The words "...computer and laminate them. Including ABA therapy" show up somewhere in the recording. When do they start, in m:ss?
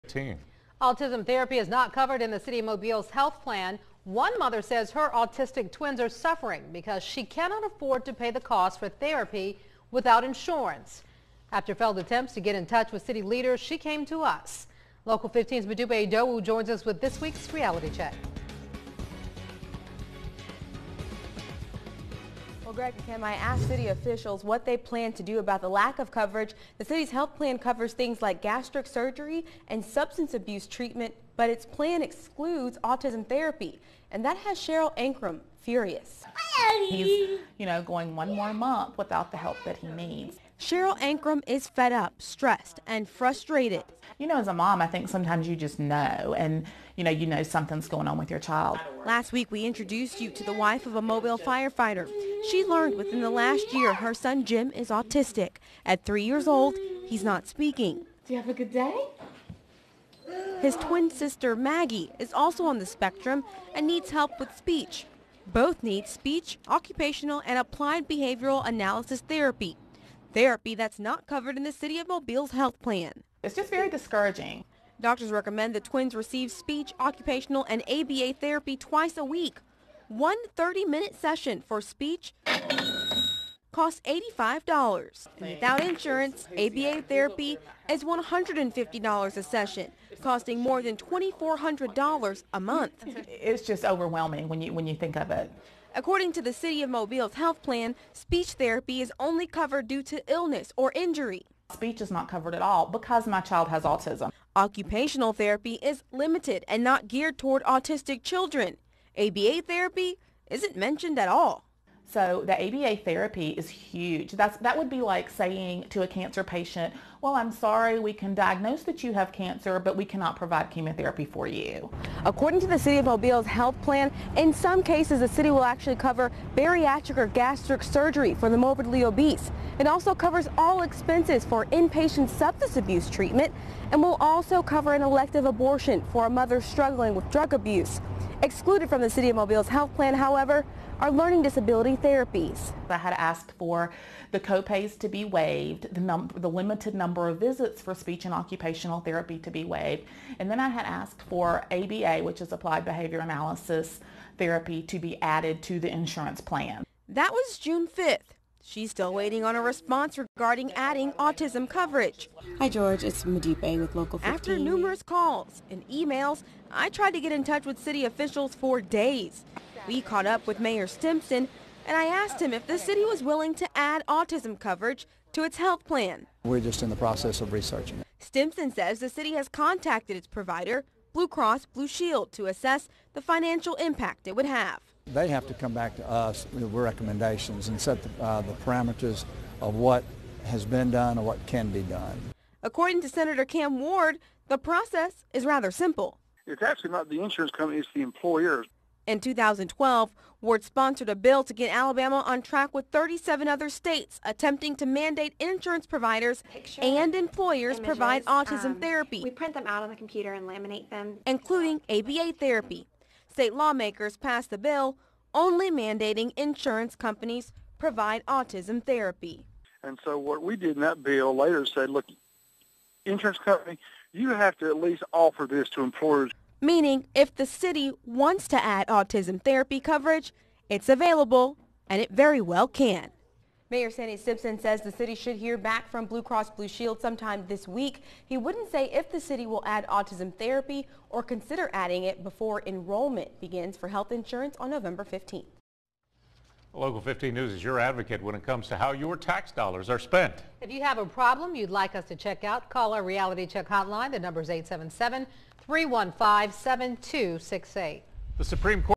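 3:29.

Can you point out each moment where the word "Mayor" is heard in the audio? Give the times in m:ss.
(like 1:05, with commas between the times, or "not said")
2:50, 3:53.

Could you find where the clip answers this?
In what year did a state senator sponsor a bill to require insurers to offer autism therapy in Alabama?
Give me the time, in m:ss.
3:19.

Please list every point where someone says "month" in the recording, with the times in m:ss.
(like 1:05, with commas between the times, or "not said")
0:38, 1:32.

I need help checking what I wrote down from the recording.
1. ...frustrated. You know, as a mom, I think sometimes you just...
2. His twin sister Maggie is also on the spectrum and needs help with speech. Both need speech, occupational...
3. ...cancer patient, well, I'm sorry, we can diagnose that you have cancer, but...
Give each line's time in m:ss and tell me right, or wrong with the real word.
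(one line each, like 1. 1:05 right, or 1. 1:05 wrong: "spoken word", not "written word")
1. 0:43 right
2. 1:00 right
3. 1:56 right.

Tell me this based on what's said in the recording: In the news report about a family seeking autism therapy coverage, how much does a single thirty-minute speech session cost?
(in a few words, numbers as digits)
$85.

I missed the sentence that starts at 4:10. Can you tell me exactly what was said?
If you have a problem you'd like us to check out, call our Reality Check hotline.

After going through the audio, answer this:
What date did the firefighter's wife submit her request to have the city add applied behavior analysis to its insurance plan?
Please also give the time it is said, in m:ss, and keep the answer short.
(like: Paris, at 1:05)
June 5th, at 2:37.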